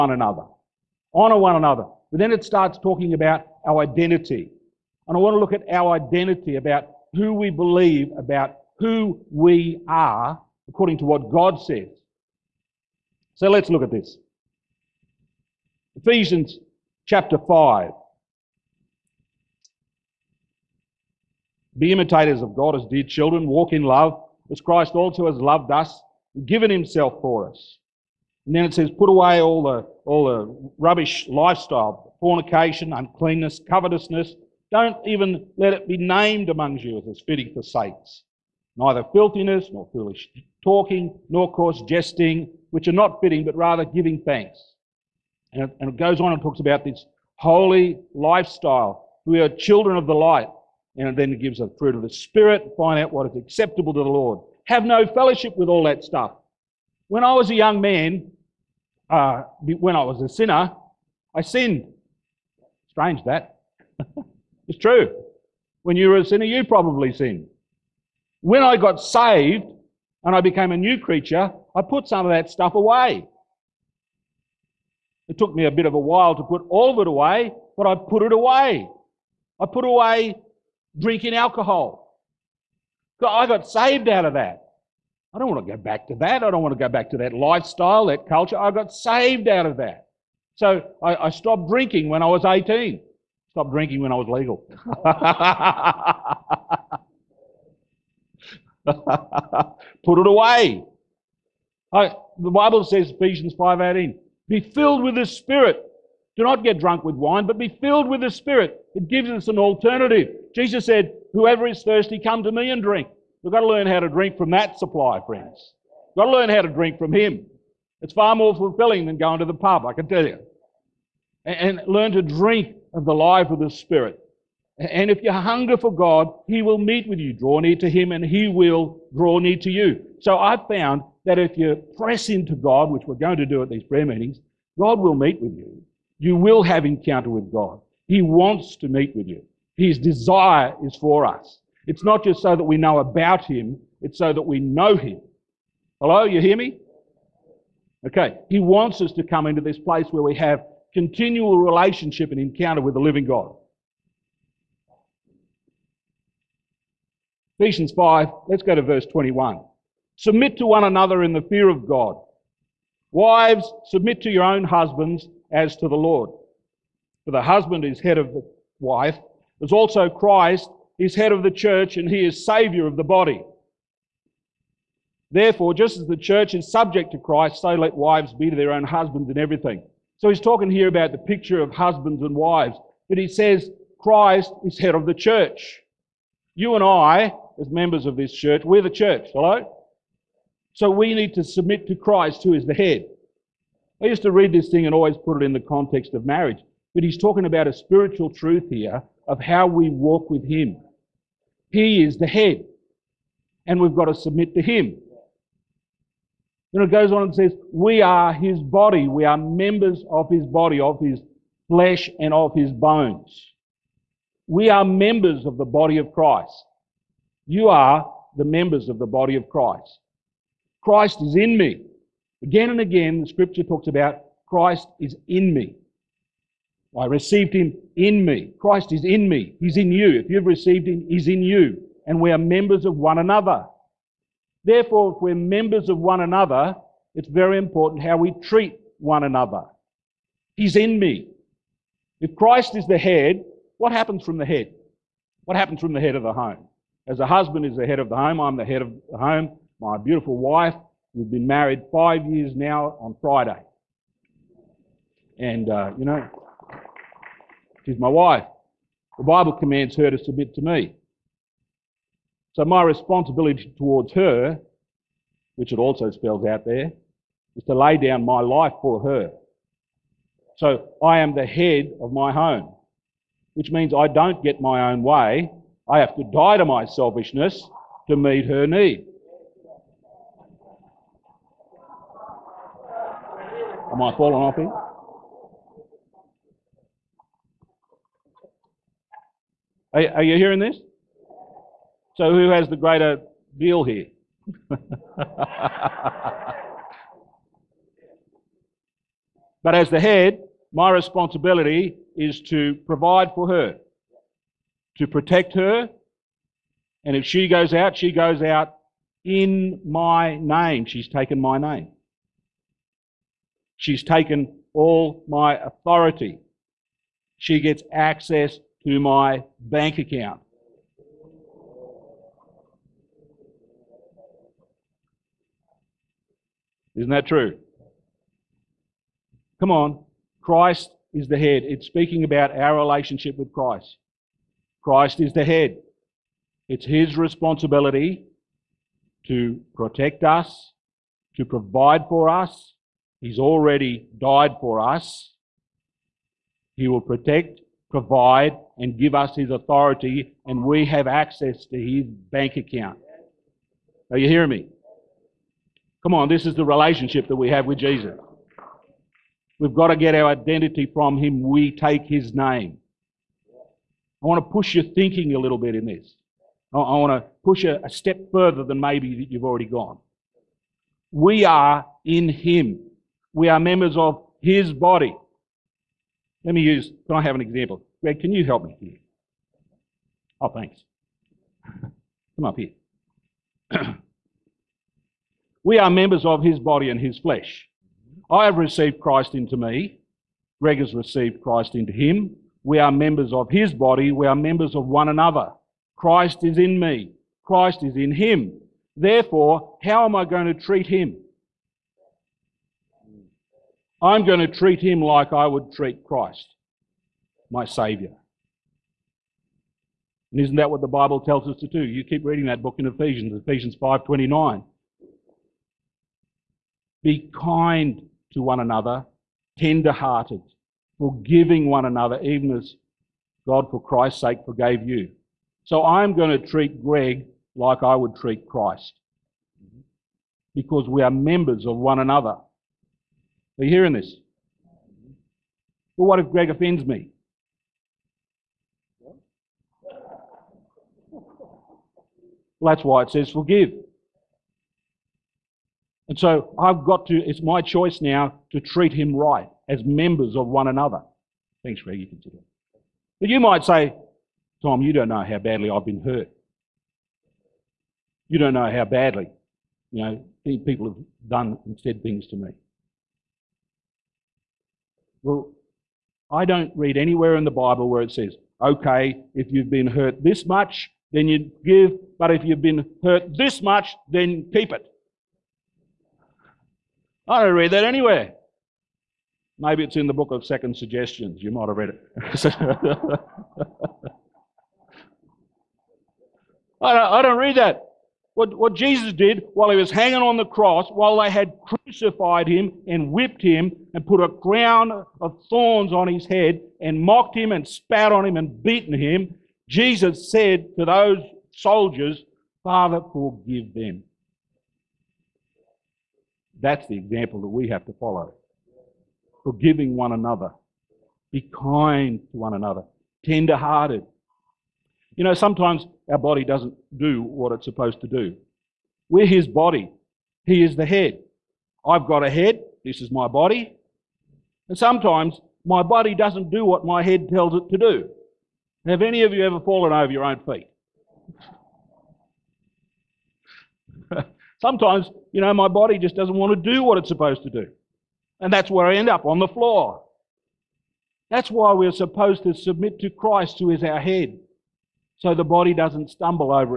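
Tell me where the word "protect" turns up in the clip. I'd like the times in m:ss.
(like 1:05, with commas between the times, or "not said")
5:05, 5:39, 5:47.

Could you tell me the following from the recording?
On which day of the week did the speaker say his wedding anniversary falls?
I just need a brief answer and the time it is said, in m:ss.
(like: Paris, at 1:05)
Friday, at 4:13.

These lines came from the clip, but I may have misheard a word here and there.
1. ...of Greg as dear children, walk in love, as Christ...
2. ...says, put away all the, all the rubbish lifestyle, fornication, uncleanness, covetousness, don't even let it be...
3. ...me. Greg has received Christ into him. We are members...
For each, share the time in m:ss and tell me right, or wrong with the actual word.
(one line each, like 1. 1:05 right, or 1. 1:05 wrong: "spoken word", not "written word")
1. 0:22 wrong: "God", not "Greg"
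2. 0:28 right
3. 6:29 right.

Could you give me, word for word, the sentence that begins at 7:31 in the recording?
Thanks, Greg, you can sit down.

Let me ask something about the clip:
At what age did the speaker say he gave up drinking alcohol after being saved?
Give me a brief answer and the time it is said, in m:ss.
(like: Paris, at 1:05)
18, at 1:32.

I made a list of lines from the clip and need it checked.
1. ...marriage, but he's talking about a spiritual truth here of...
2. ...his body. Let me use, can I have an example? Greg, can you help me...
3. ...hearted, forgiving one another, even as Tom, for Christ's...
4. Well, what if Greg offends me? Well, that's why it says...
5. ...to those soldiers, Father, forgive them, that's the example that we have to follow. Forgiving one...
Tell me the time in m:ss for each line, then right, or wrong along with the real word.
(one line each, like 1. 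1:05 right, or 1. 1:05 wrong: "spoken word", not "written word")
1. 3:16 right
2. 6:14 right
3. 6:59 wrong: "God", not "Tom"
4. 7:15 right
5. 8:20 right.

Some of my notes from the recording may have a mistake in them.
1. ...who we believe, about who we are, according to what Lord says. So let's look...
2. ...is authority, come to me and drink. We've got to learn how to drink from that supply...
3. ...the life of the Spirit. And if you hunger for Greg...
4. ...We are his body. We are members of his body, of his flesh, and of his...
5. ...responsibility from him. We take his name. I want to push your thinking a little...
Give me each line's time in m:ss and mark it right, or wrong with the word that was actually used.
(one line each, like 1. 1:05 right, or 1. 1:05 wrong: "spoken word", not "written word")
1. 0:07 wrong: "God", not "Lord"
2. 1:51 wrong: "thirsty", not "authority"
3. 2:03 wrong: "God", not "Greg"
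4. 3:27 right
5. 6:00 wrong: "identity", not "responsibility".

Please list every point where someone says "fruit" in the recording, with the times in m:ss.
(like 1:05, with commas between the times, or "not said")
0:51.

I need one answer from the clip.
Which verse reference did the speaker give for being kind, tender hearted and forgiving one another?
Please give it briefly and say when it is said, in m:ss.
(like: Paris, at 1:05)
Ephesians 5.29, at 6:53.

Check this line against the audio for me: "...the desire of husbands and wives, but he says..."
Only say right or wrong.
wrong.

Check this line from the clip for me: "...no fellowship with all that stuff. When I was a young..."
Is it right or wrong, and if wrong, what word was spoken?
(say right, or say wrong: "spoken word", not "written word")
right.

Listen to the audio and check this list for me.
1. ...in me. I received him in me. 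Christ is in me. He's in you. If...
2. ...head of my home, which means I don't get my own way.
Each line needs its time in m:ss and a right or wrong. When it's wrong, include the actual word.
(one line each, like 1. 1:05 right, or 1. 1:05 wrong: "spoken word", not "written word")
1. 3:45 right
2. 4:31 right.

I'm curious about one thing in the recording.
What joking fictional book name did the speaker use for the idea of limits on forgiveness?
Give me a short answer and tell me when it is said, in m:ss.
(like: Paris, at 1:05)
Second Suggestions, at 8:00.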